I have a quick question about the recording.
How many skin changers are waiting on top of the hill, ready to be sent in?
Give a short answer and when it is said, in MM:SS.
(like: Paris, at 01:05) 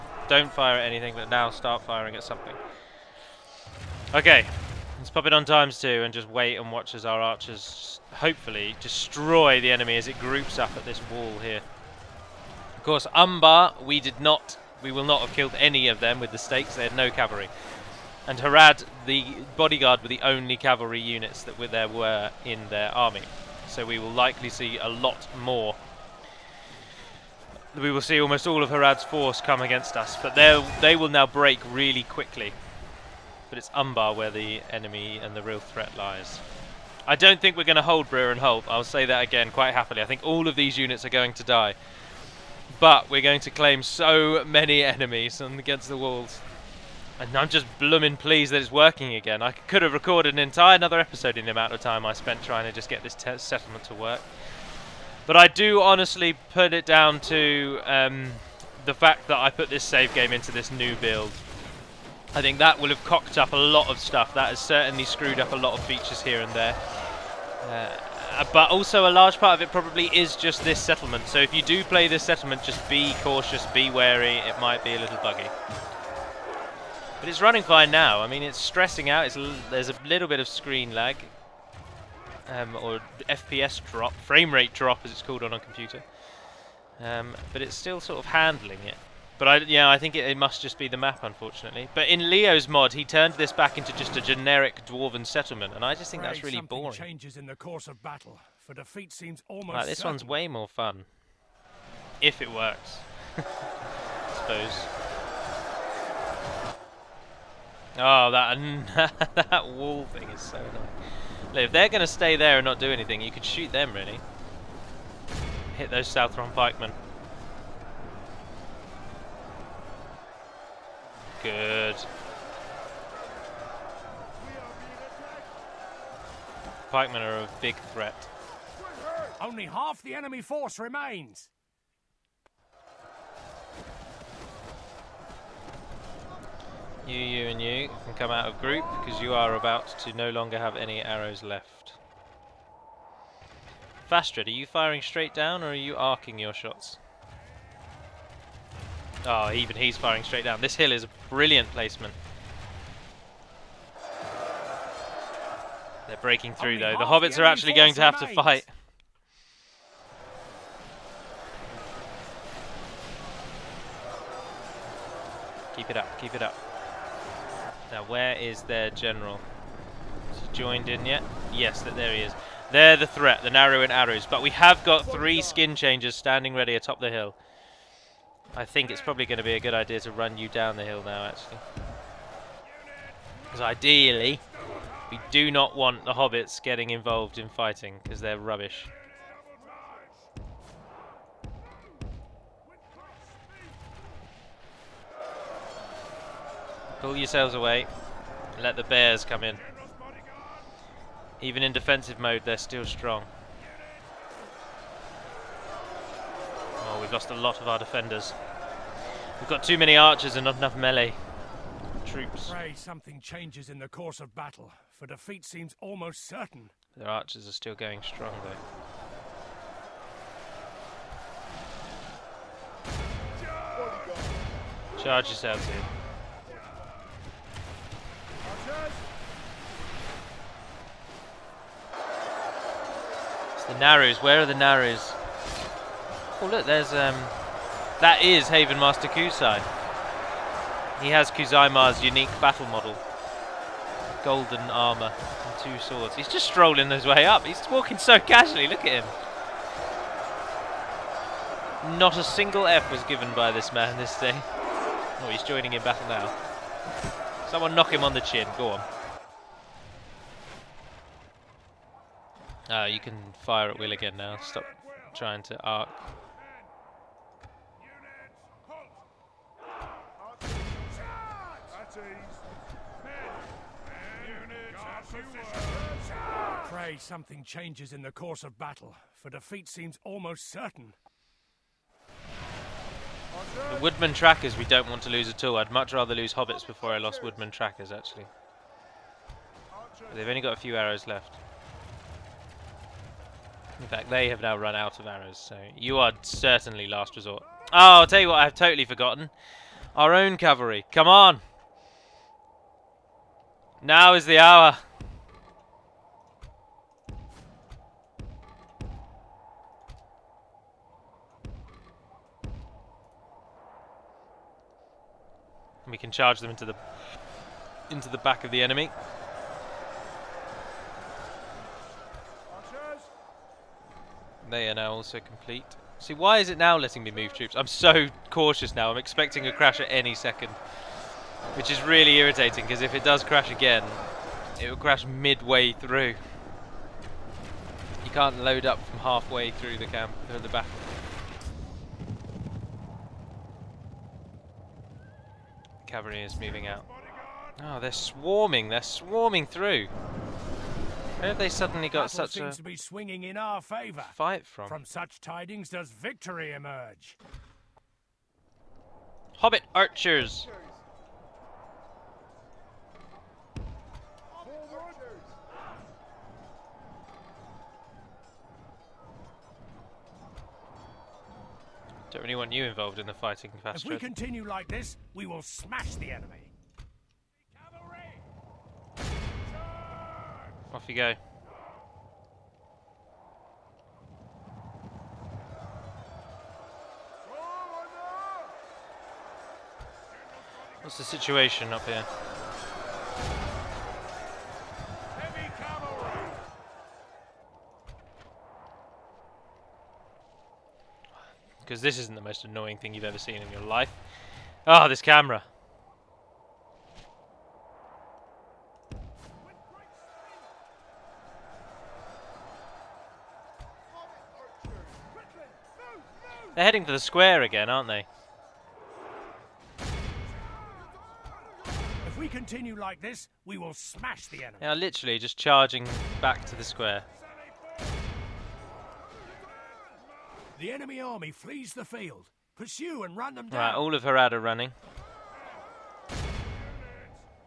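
3, at 02:55.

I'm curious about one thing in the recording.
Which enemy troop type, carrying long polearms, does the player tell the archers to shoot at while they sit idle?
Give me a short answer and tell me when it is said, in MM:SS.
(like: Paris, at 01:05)
Southron pikemen, at 01:56.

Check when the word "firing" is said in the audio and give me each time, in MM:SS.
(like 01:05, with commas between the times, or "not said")
00:01, 02:24, 02:29.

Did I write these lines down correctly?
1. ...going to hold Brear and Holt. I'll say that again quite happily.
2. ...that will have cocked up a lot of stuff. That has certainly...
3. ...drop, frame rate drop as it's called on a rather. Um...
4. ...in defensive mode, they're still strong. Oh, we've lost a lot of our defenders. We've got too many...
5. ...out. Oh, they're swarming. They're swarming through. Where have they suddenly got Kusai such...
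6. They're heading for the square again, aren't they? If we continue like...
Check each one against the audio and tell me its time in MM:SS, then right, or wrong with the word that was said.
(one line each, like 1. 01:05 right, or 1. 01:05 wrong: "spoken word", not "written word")
1. 00:37 right
2. 01:02 right
3. 01:23 wrong: "computer", not "rather"
4. 03:21 right
5. 05:46 wrong: "Battle", not "Kusai"
6. 06:56 right.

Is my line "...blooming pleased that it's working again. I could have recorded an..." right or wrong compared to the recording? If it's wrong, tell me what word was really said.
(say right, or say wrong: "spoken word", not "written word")
right.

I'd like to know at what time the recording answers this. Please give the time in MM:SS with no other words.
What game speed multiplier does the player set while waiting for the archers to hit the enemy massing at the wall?
00:05.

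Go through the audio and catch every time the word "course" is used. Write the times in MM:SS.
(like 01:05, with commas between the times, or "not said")
00:12, 01:37, 03:33, 04:38.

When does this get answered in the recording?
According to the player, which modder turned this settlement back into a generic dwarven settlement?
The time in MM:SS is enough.
01:32.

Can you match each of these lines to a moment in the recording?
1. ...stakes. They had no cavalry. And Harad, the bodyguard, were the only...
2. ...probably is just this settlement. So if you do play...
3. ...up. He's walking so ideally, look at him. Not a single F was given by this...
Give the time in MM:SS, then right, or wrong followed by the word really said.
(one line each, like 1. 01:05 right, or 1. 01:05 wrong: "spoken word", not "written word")
1. 00:16 right
2. 01:09 right
3. 04:07 wrong: "casually", not "ideally".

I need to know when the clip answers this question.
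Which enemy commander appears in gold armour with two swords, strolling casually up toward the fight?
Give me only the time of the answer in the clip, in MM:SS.
03:58.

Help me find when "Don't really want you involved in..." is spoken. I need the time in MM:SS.
06:12.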